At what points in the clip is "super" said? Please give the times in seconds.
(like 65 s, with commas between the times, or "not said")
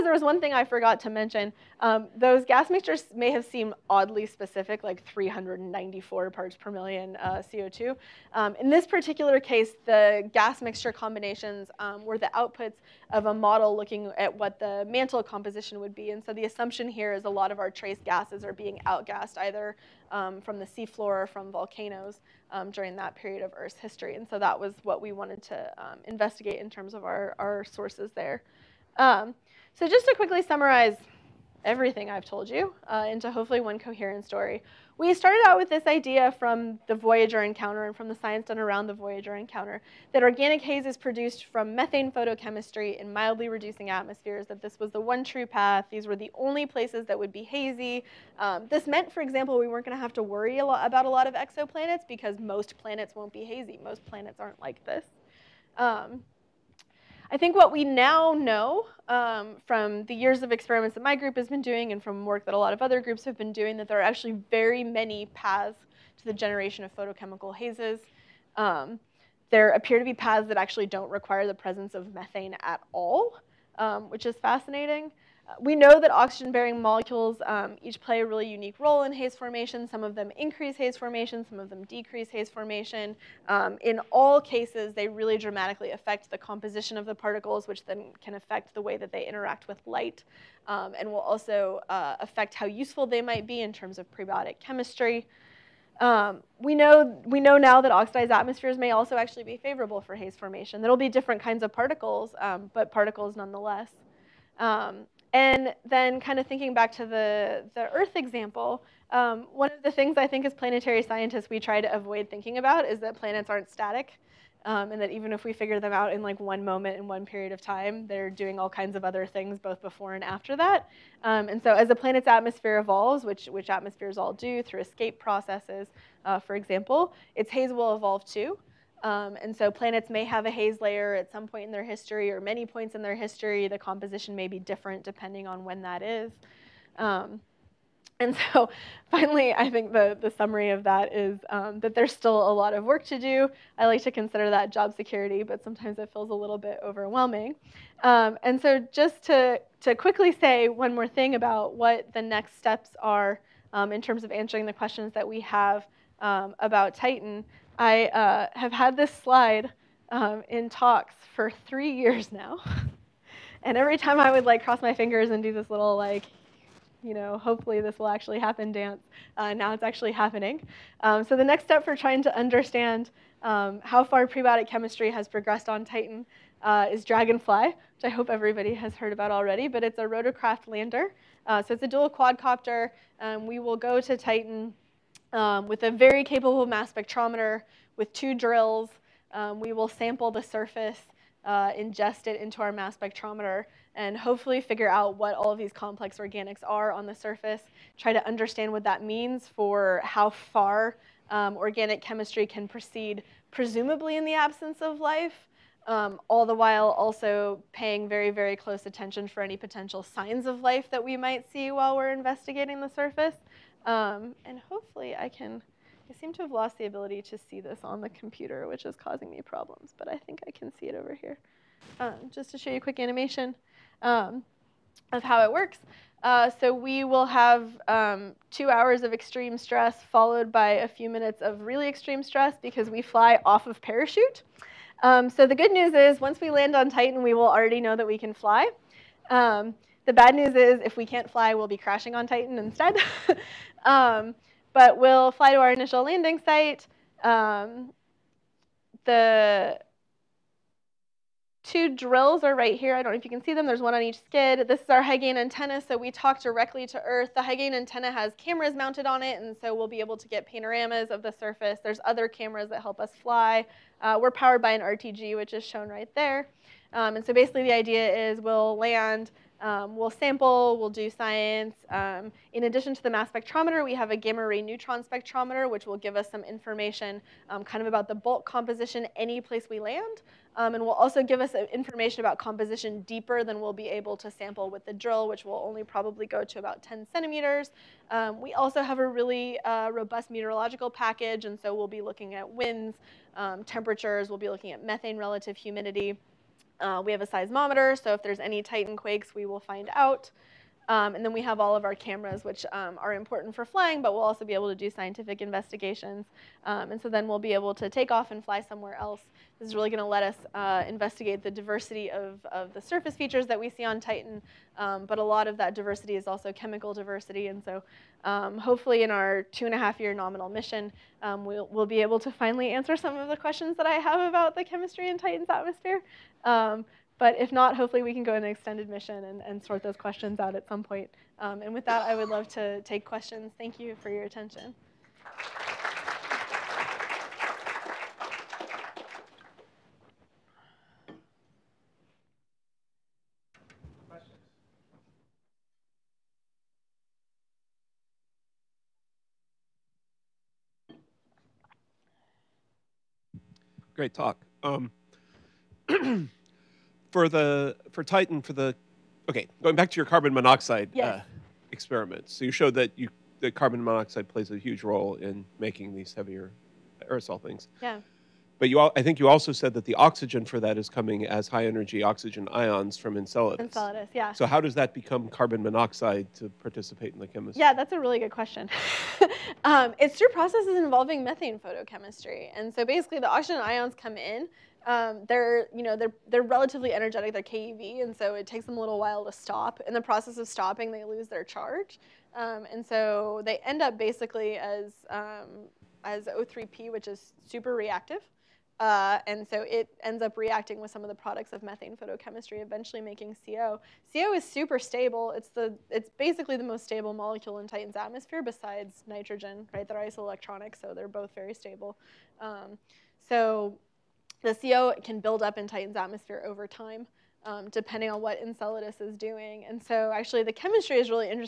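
397 s, 404 s.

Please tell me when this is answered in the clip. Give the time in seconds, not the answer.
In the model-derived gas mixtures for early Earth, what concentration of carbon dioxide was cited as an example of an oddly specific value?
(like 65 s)
5 s.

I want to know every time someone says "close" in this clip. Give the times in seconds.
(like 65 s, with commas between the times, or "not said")
208 s.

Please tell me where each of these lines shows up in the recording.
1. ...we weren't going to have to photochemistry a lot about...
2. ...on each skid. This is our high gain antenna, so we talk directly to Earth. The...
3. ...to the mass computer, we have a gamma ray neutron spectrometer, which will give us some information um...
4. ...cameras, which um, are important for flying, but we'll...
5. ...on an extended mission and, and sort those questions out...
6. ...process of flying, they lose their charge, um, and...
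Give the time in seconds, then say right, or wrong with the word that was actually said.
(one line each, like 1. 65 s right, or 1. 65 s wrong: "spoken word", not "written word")
1. 49 s wrong: "worry", not "photochemistry"
2. 253 s right
3. 272 s wrong: "spectrometer", not "computer"
4. 301 s right
5. 328 s right
6. 390 s wrong: "stopping", not "flying".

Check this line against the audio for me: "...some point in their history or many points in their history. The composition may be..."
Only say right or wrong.
right.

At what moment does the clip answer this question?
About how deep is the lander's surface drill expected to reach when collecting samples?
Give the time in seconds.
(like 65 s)
286 s.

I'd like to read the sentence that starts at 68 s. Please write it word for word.
Um, there appear to be paths that actually don't require the presence of methane at all, um, which is fascinating.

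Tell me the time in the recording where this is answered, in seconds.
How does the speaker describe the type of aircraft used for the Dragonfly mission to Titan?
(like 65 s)
180 s.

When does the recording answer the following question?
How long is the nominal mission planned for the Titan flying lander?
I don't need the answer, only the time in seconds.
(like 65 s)
319 s.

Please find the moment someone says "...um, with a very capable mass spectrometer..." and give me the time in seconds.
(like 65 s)
185 s.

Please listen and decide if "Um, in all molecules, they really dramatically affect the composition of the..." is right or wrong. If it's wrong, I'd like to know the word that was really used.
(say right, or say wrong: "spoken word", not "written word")
wrong: "cases", not "molecules".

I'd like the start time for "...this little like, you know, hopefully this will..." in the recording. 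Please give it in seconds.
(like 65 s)
165 s.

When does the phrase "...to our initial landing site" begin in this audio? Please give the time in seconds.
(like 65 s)
245 s.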